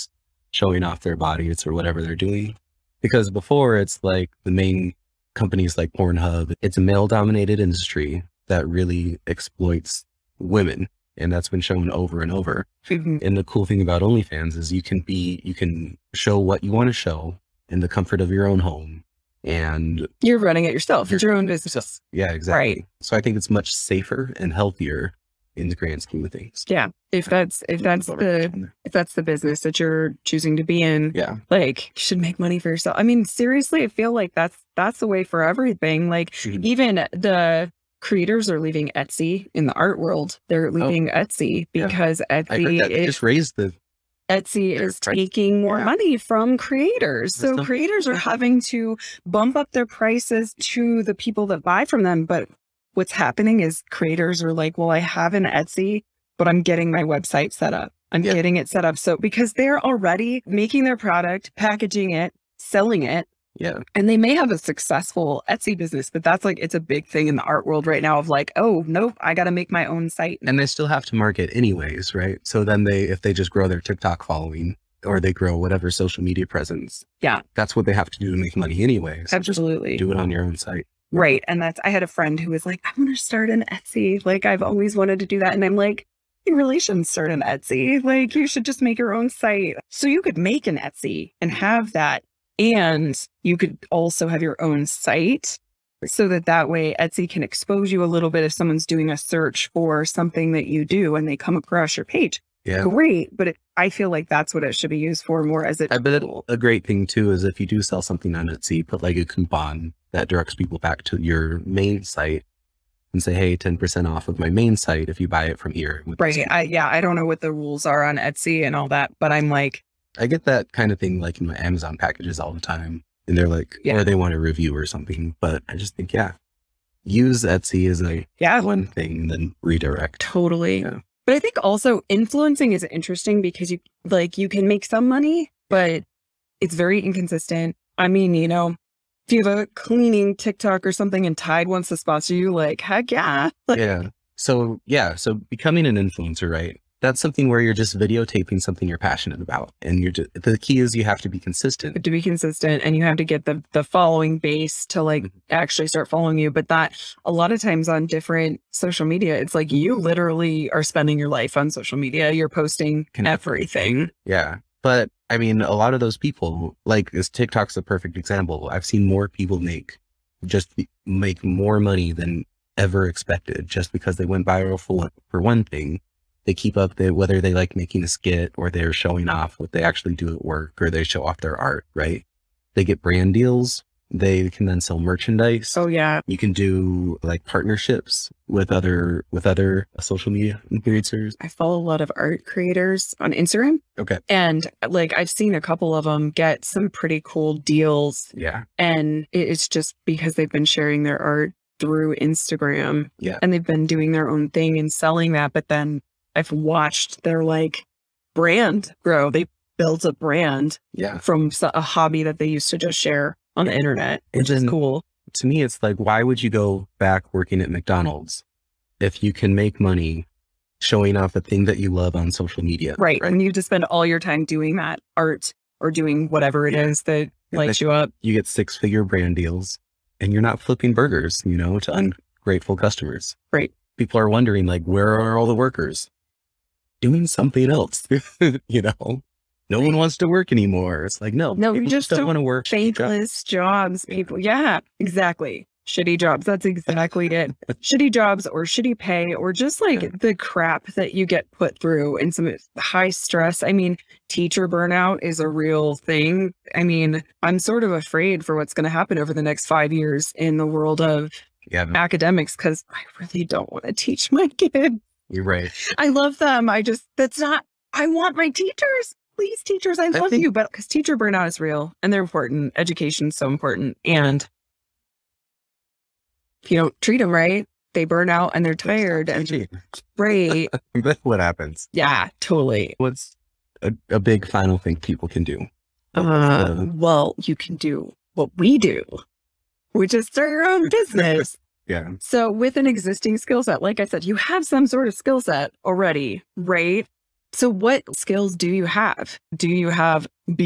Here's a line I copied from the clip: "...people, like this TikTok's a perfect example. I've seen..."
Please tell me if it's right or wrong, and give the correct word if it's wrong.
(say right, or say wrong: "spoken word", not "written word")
right.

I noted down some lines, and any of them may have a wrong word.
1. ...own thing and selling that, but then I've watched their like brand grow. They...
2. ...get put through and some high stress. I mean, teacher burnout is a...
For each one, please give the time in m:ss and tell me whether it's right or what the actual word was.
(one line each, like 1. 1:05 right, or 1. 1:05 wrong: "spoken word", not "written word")
1. 3:24 right
2. 4:11 right.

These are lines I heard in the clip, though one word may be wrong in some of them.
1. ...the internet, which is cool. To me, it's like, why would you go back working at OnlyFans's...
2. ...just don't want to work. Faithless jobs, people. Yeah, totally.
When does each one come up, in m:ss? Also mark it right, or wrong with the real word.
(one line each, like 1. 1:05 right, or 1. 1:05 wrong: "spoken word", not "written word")
1. 3:33 wrong: "McDonald", not "OnlyFans"
2. 4:01 wrong: "exactly", not "totally".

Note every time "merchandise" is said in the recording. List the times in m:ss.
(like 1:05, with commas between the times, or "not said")
3:04.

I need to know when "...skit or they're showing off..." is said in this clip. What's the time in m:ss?
2:58.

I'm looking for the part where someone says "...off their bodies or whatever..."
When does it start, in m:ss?
0:00.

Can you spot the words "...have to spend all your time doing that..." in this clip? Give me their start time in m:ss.
3:43.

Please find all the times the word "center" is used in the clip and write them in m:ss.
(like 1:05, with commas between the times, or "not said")
not said.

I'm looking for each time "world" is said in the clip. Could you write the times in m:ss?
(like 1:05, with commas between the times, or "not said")
0:39, 1:07, 4:20.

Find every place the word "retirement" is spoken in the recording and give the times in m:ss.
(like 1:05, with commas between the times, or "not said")
not said.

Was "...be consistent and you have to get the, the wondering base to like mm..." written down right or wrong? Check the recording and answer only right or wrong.
wrong.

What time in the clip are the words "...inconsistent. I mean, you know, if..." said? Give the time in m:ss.
2:16.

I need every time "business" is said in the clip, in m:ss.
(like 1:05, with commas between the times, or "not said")
0:21, 0:29, 1:05, 4:50.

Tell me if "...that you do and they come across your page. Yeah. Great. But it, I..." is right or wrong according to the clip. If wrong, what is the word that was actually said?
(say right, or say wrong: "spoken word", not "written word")
right.